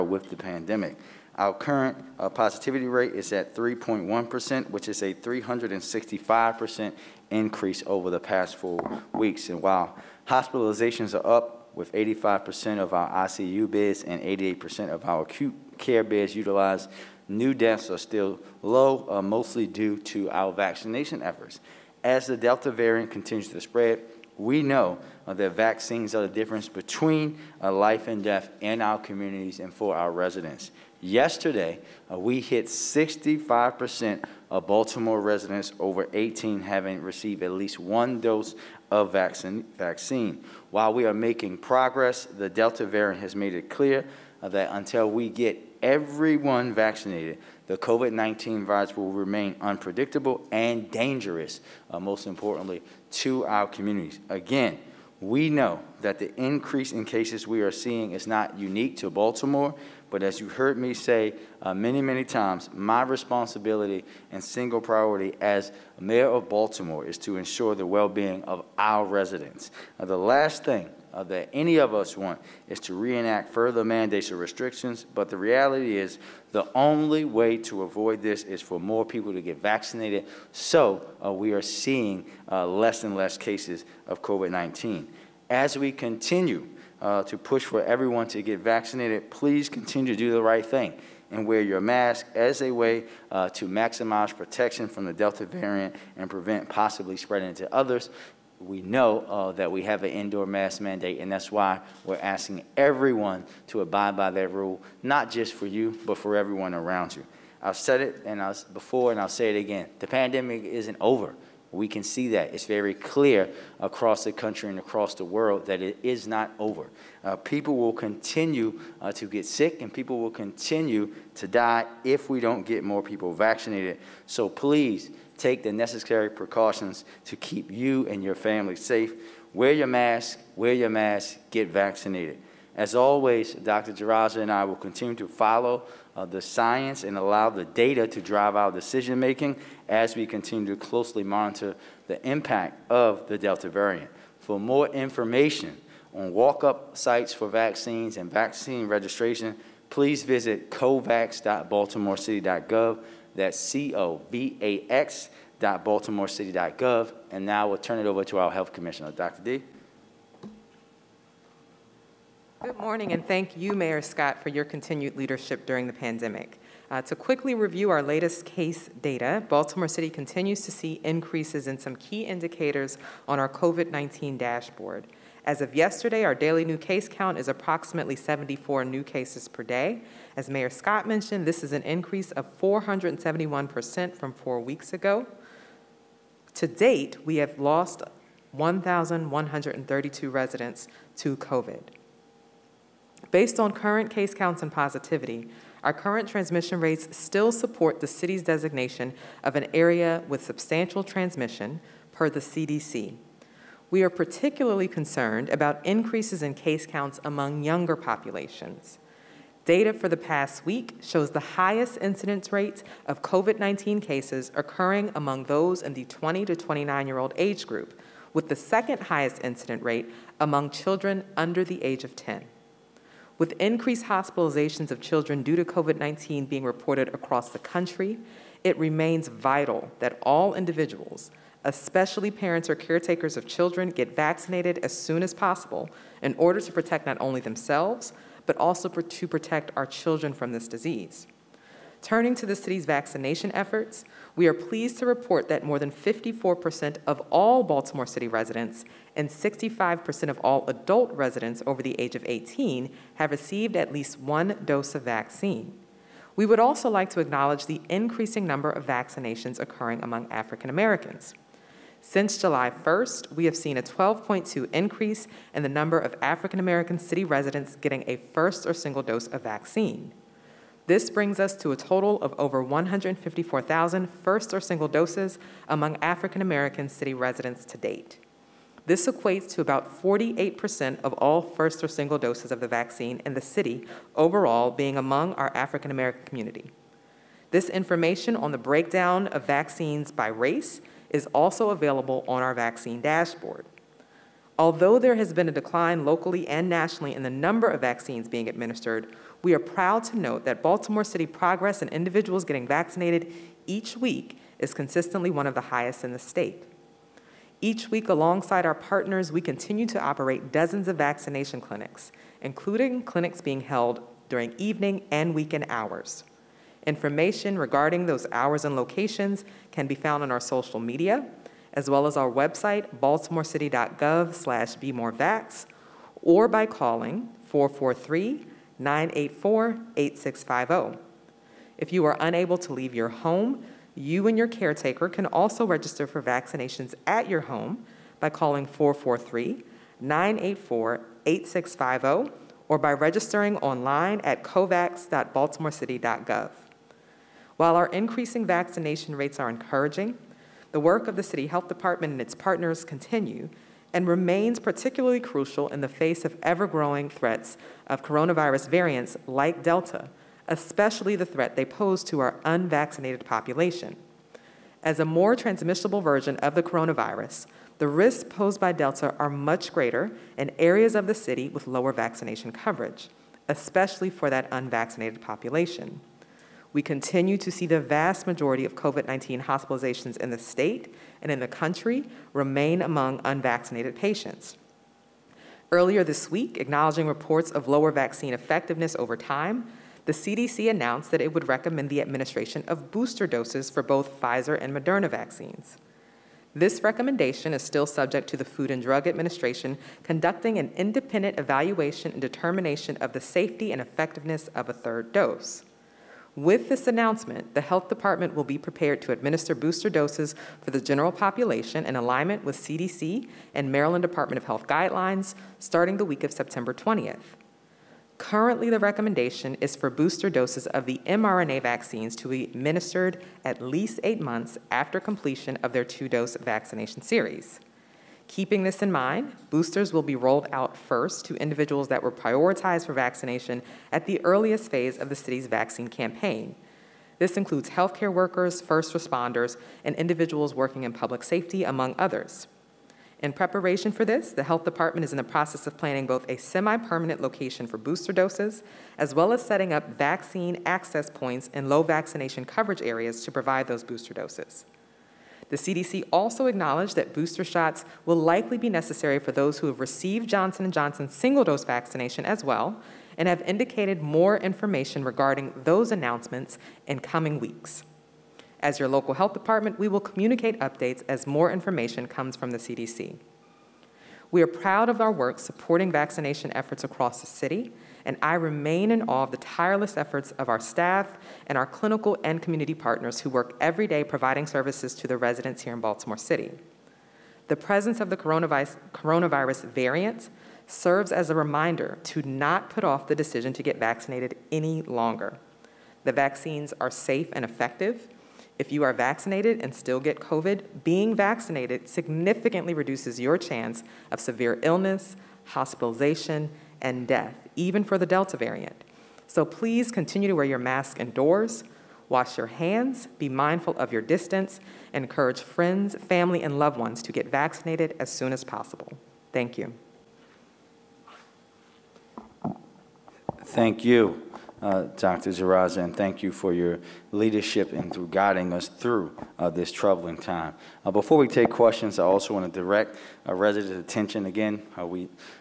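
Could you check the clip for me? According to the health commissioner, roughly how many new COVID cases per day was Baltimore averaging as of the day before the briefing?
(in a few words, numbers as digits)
74.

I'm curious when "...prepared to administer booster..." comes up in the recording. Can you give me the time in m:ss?
6:48.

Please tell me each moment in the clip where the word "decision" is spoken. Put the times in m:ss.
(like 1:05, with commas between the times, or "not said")
2:18, 8:13.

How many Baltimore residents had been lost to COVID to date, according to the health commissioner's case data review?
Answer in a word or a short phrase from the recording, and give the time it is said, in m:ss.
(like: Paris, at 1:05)
1,132, at 3:08.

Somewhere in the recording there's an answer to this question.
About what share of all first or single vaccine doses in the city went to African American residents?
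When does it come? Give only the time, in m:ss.
4:40.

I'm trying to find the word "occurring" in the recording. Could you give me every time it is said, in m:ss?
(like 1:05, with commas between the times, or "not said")
3:34, 4:19.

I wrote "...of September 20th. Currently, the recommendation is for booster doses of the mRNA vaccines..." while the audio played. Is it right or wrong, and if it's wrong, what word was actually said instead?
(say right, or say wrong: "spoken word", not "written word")
right.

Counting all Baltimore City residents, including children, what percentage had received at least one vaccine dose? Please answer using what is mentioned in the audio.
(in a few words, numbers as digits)
54%.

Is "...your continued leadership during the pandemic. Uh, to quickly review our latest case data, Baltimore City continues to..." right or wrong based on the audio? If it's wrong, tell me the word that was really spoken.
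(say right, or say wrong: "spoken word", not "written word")
right.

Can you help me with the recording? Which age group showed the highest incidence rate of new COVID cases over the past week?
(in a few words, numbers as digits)
20 to 29.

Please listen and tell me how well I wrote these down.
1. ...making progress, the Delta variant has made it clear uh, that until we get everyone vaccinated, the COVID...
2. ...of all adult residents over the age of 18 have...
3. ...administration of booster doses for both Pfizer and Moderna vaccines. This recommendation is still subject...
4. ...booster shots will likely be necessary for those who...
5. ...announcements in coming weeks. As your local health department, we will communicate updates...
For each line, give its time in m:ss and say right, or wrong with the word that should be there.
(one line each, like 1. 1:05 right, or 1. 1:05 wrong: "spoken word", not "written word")
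1. 0:41 right
2. 4:10 right
3. 6:32 right
4. 7:37 right
5. 7:45 right.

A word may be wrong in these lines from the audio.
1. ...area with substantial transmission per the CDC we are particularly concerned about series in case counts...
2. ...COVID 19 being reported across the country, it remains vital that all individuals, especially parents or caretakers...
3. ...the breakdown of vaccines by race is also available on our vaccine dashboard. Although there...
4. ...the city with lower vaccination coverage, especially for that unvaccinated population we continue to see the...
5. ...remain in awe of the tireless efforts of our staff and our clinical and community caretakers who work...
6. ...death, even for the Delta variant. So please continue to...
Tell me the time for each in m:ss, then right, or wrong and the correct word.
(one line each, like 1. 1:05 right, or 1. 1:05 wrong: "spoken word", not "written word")
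1. 3:19 wrong: "increases", not "series"
2. 3:45 right
3. 4:48 right
4. 6:11 right
5. 7:58 wrong: "partners", not "caretakers"
6. 8:27 right.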